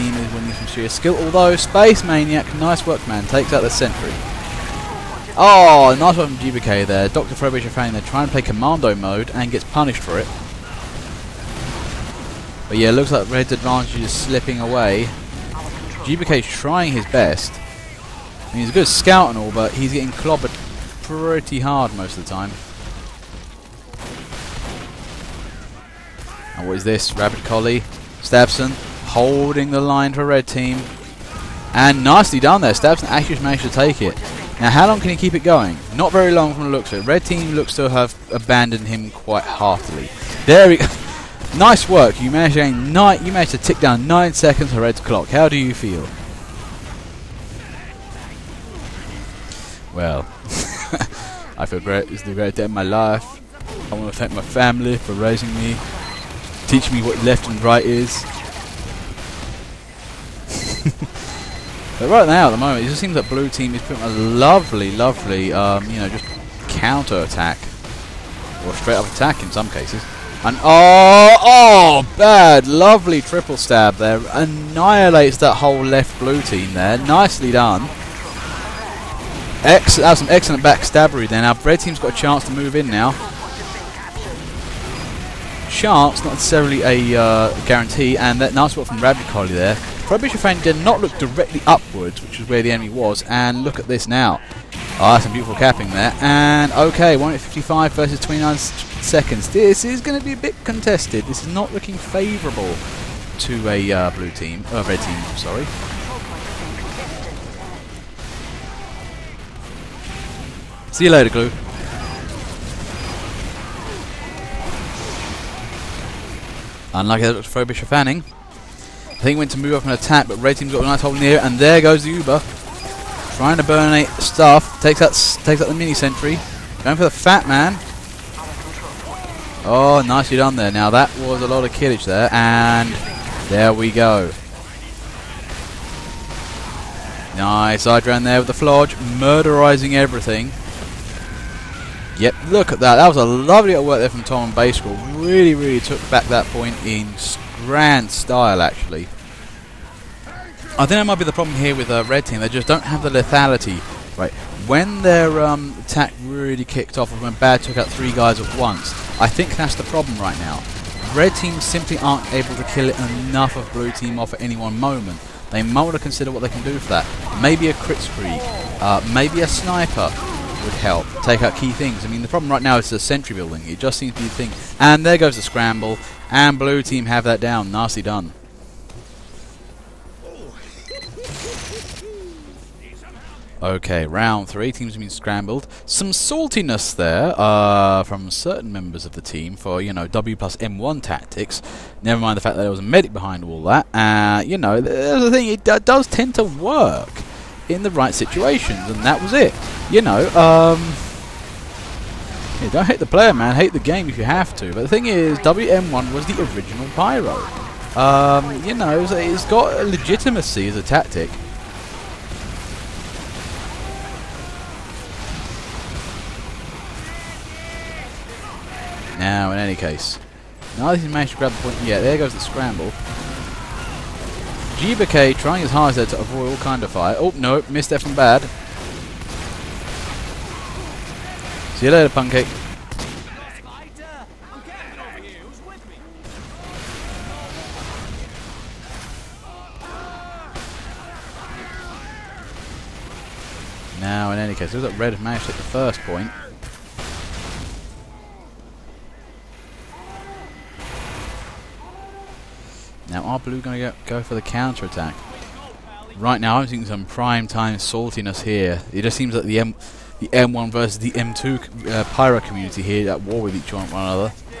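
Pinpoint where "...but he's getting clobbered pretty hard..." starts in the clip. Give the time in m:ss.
0:19.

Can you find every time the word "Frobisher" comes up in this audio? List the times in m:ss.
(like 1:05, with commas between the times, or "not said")
0:07, 1:57.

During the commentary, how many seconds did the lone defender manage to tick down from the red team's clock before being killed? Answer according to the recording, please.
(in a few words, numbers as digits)
9.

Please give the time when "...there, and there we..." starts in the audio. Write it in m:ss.
2:12.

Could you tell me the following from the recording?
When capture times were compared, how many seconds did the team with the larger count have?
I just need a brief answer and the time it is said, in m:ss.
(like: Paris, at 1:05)
155, at 1:37.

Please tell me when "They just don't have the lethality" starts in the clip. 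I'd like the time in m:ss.
2:32.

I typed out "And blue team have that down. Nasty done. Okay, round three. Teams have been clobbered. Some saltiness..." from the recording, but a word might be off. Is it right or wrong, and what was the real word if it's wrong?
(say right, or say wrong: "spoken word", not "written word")
wrong: "scrambled", not "clobbered".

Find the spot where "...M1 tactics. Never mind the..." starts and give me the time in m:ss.
3:10.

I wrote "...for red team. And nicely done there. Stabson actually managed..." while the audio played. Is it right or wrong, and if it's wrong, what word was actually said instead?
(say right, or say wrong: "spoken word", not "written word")
right.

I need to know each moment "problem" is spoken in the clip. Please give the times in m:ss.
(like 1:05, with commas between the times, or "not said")
2:31, 2:39, 2:52.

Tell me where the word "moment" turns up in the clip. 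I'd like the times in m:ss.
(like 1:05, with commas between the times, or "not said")
1:02, 2:44.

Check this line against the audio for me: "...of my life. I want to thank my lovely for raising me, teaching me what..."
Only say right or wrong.
wrong.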